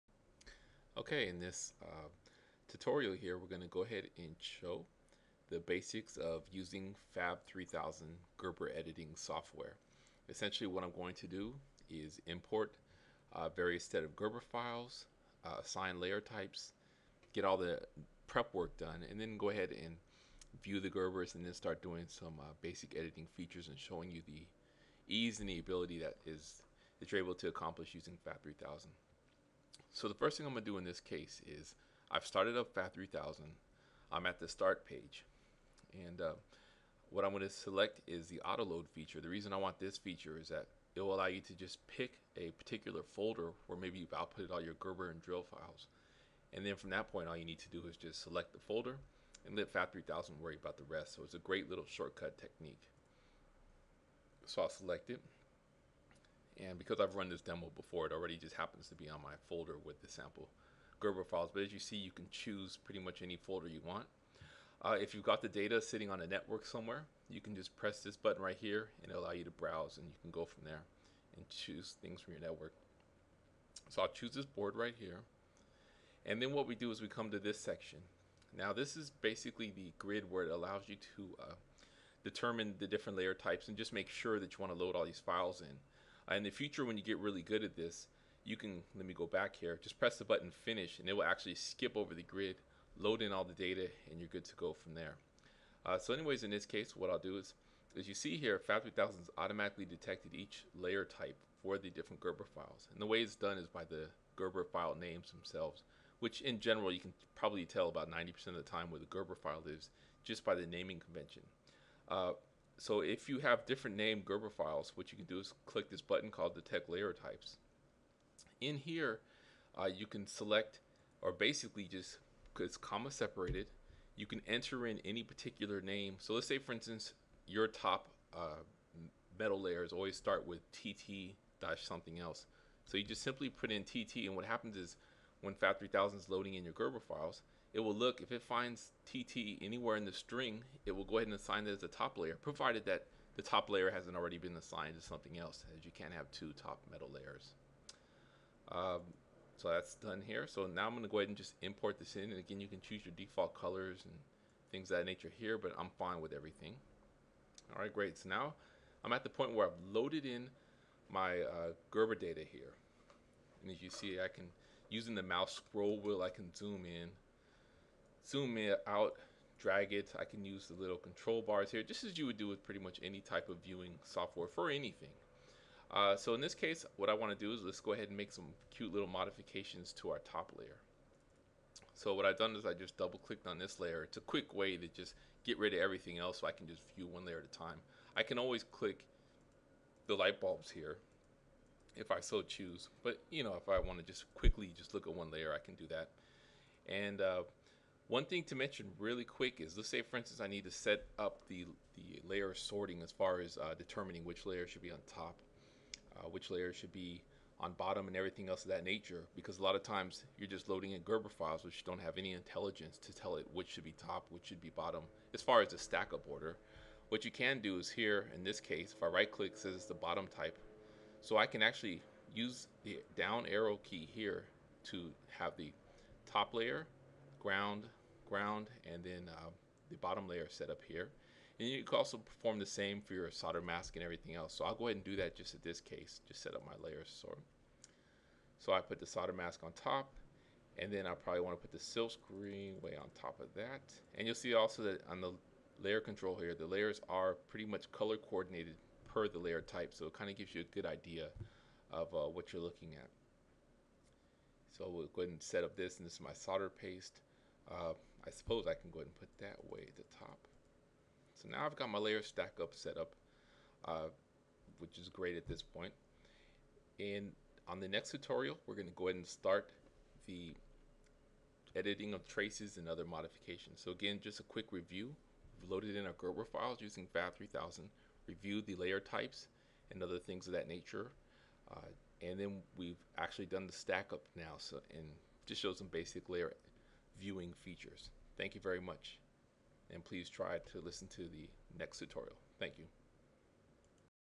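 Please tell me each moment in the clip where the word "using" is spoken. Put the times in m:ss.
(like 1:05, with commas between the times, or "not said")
0:06, 0:27, 2:44, 4:36.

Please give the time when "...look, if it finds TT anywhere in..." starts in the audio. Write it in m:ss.
2:17.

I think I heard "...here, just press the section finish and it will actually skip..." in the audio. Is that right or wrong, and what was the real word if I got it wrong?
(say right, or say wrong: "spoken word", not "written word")
wrong: "button", not "section".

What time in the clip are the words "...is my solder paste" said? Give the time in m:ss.
4:16.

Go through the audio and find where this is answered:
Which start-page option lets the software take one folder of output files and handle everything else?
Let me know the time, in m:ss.
0:38.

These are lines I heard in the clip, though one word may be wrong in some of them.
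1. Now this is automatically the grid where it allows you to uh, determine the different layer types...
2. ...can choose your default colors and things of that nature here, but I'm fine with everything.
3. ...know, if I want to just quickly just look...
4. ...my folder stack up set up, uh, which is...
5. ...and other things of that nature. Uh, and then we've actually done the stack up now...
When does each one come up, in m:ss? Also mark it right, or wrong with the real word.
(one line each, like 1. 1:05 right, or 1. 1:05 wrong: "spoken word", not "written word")
1. 1:18 wrong: "basically", not "automatically"
2. 2:32 right
3. 3:13 right
4. 4:21 wrong: "layer", not "folder"
5. 4:39 right.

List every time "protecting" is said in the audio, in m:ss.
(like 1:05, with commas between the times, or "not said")
not said.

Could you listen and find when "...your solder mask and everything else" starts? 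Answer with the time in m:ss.
3:53.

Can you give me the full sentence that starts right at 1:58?
In here, uh, you can select, or basically just, it's comma separated, you can enter in any particular name.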